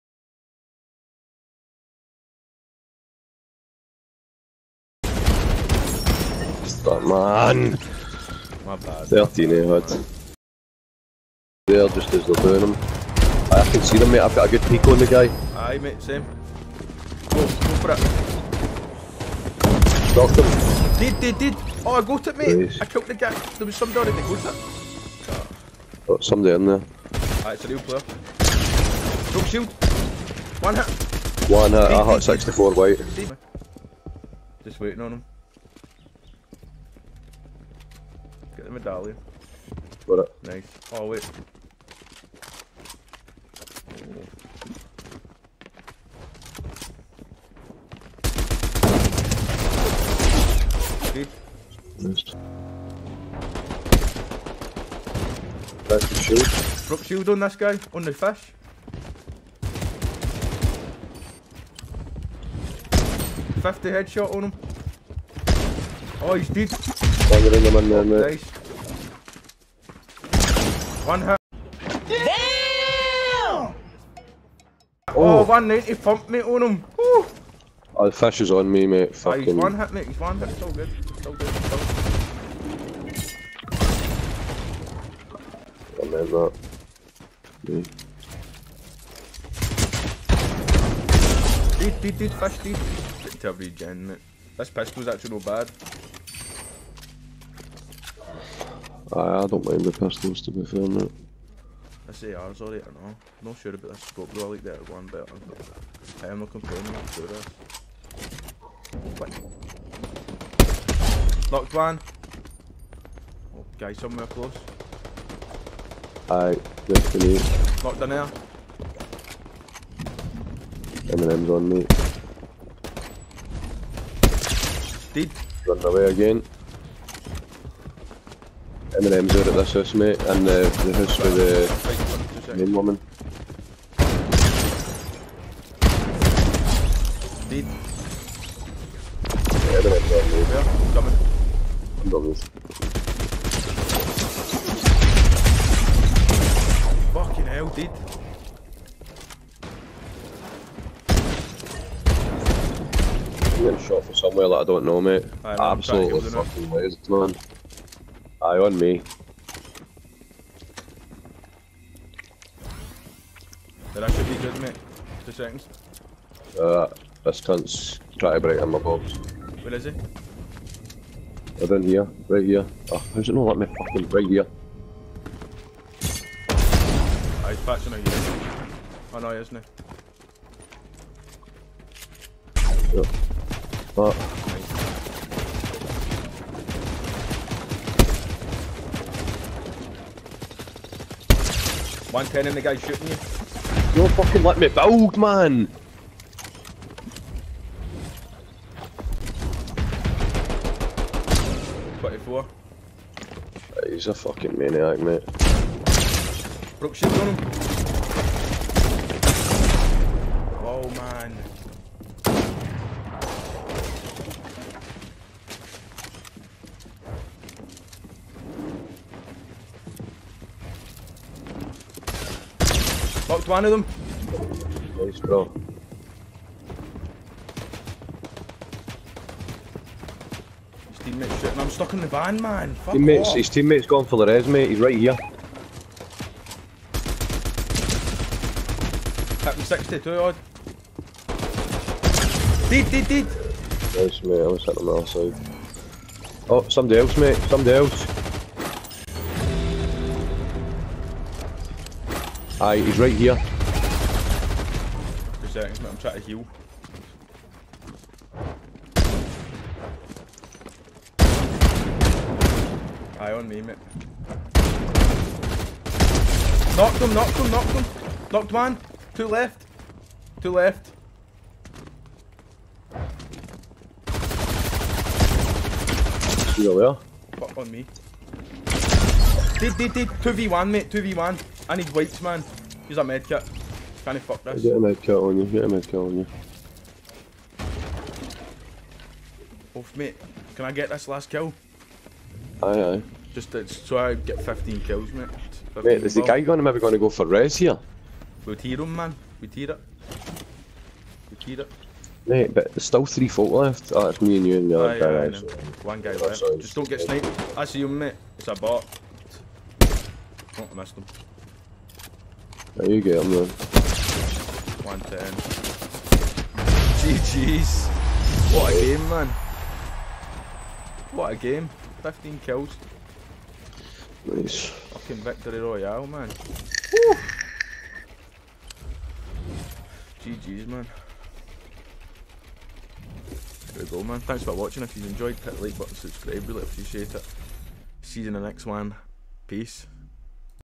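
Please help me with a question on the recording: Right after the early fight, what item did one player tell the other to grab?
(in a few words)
medallion.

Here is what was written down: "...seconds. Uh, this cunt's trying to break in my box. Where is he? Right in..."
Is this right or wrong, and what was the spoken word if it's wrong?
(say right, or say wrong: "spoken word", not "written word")
right.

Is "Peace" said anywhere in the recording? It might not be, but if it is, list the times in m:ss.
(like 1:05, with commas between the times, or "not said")
5:39.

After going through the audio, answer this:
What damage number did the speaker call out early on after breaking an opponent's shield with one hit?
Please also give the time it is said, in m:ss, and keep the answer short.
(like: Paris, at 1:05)
64, at 0:32.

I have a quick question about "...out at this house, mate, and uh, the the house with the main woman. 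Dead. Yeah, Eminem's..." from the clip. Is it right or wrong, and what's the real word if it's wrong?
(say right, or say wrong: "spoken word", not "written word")
right.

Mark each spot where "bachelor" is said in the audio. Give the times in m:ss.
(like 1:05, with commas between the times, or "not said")
not said.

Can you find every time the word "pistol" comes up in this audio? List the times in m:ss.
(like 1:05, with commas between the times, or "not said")
1:34, 1:39.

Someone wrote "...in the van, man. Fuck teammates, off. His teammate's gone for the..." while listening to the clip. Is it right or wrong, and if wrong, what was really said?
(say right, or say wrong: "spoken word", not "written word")
right.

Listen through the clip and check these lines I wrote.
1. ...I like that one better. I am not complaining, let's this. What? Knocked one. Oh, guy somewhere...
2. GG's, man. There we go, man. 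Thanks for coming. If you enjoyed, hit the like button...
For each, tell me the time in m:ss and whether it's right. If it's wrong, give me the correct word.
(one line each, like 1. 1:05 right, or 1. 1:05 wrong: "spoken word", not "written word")
1. 1:44 right
2. 5:30 wrong: "watching", not "coming".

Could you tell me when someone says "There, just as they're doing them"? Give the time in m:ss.
0:11.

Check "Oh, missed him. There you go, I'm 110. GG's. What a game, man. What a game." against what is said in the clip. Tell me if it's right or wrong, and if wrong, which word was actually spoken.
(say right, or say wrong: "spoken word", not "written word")
right.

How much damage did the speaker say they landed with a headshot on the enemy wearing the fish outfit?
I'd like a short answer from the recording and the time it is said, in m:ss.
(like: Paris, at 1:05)
50, at 1:03.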